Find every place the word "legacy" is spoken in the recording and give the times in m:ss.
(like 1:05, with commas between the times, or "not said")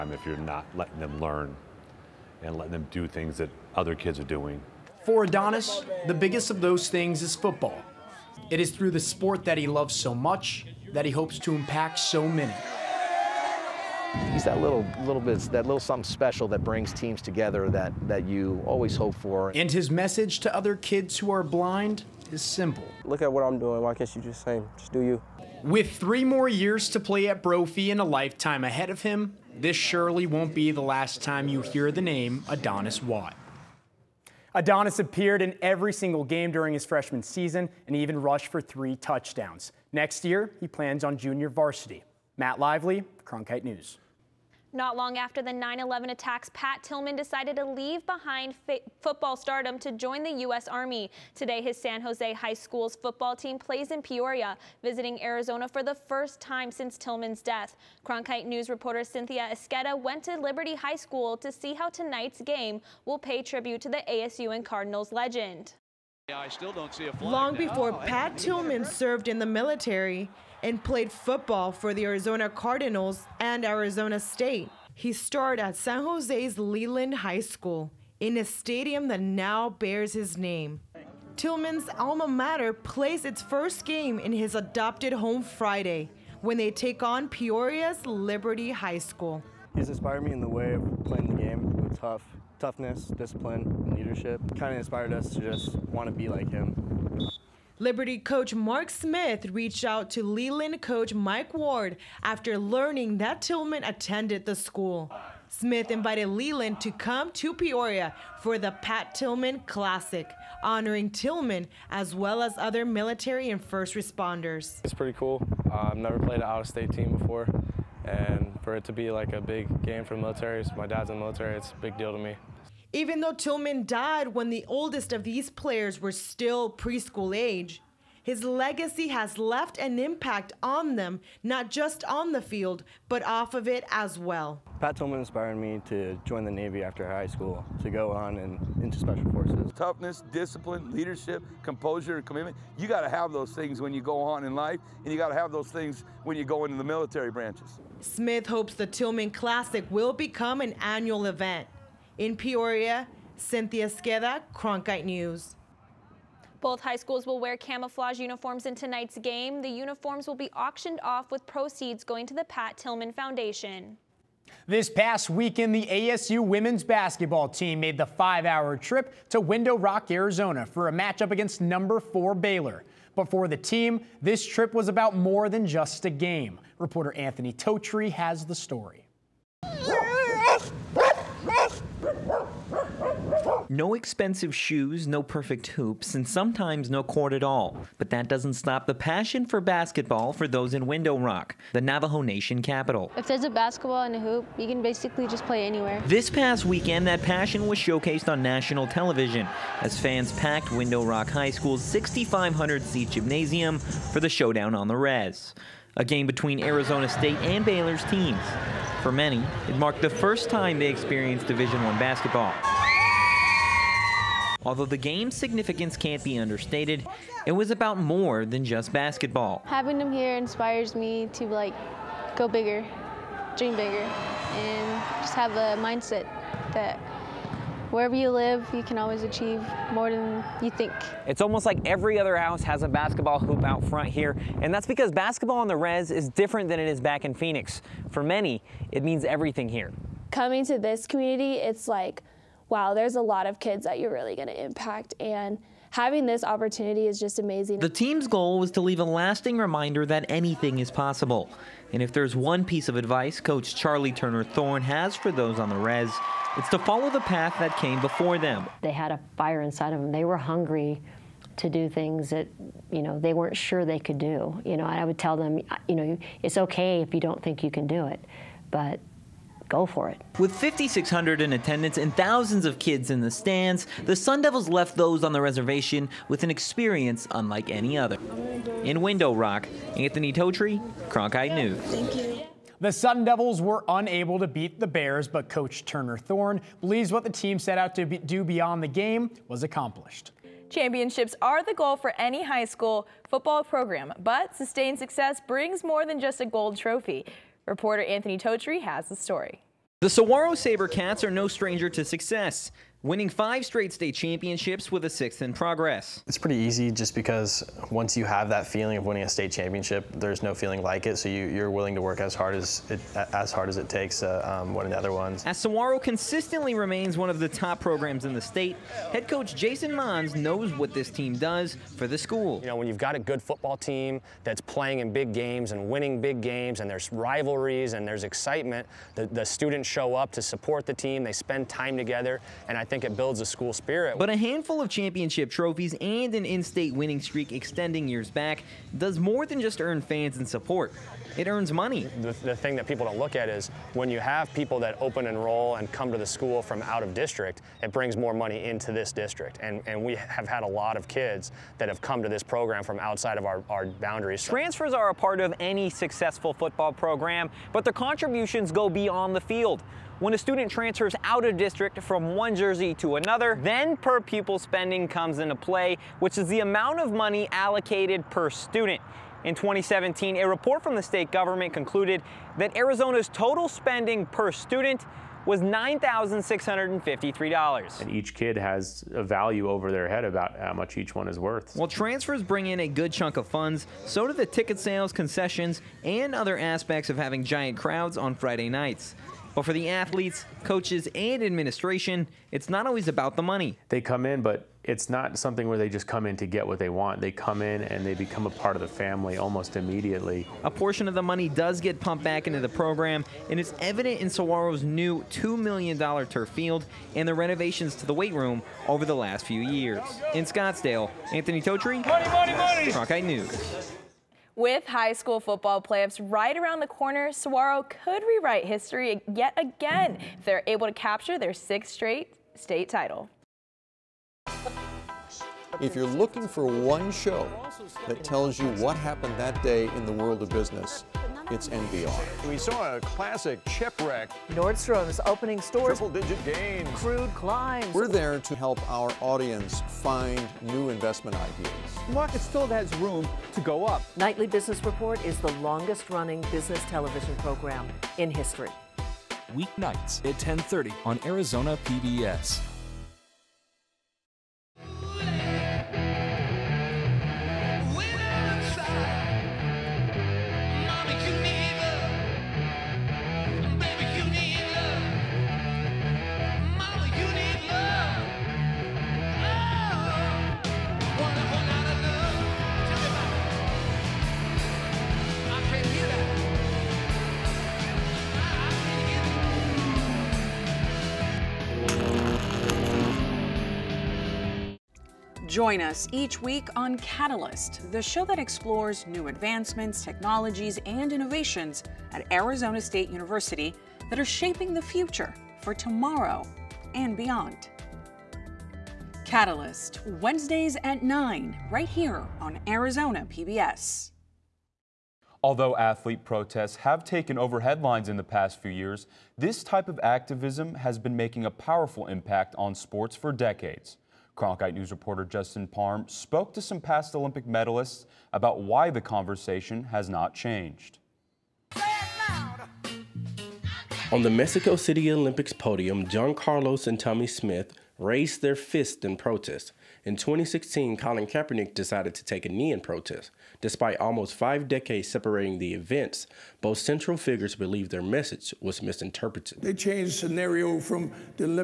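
2:08.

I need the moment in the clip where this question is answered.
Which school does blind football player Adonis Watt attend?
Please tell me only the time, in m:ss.
0:27.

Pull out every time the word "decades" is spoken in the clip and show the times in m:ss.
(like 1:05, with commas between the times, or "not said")
8:33, 8:54.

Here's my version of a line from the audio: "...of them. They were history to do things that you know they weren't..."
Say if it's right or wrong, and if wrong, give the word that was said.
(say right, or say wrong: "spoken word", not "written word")
wrong: "hungry", not "history".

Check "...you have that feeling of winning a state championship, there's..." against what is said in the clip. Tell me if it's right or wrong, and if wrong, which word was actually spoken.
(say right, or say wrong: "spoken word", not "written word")
right.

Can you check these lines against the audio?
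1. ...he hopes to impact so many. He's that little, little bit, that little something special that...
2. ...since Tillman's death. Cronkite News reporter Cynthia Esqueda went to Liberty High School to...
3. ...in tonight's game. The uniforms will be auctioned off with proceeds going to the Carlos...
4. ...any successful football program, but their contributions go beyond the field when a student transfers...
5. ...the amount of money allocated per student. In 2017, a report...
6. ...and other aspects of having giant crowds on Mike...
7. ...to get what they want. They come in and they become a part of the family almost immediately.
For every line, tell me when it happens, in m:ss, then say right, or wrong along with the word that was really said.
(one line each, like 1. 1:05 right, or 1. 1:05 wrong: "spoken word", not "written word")
1. 0:11 right
2. 0:56 right
3. 2:38 wrong: "Pat", not "Carlos"
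4. 5:55 right
5. 6:06 right
6. 6:26 wrong: "Friday", not "Mike"
7. 6:36 right.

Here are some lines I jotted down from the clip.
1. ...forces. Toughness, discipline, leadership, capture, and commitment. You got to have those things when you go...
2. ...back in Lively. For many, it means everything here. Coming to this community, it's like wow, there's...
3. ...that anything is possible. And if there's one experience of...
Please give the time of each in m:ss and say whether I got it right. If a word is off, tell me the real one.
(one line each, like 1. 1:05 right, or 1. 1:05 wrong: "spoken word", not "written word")
1. 2:19 wrong: "composure", not "capture"
2. 3:56 wrong: "Phoenix", not "Lively"
3. 4:10 wrong: "piece", not "experience".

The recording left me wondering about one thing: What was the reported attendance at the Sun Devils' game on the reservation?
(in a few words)
5,600.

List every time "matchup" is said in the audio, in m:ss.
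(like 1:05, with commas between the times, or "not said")
2:50.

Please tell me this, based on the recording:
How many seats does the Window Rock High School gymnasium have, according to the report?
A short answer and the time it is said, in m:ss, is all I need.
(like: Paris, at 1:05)
6,500, at 3:21.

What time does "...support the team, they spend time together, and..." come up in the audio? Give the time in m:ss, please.
5:30.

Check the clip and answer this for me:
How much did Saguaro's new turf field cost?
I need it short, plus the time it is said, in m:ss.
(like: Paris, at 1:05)
$2 million, at 6:45.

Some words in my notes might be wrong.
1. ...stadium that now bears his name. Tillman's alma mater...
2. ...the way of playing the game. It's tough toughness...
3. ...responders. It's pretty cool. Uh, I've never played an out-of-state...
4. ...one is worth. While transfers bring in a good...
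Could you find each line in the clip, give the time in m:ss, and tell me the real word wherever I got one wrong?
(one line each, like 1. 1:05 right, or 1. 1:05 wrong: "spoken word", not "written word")
1. 1:18 right
2. 1:30 right
3. 1:53 right
4. 6:21 right.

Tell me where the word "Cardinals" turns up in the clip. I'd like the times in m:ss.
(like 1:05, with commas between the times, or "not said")
1:04, 1:12.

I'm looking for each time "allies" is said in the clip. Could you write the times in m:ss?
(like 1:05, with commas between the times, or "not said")
not said.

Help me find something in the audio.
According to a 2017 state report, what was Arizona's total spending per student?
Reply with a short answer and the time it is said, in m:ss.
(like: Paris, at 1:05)
$9,653, at 6:15.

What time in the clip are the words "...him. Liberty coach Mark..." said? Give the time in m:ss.
1:36.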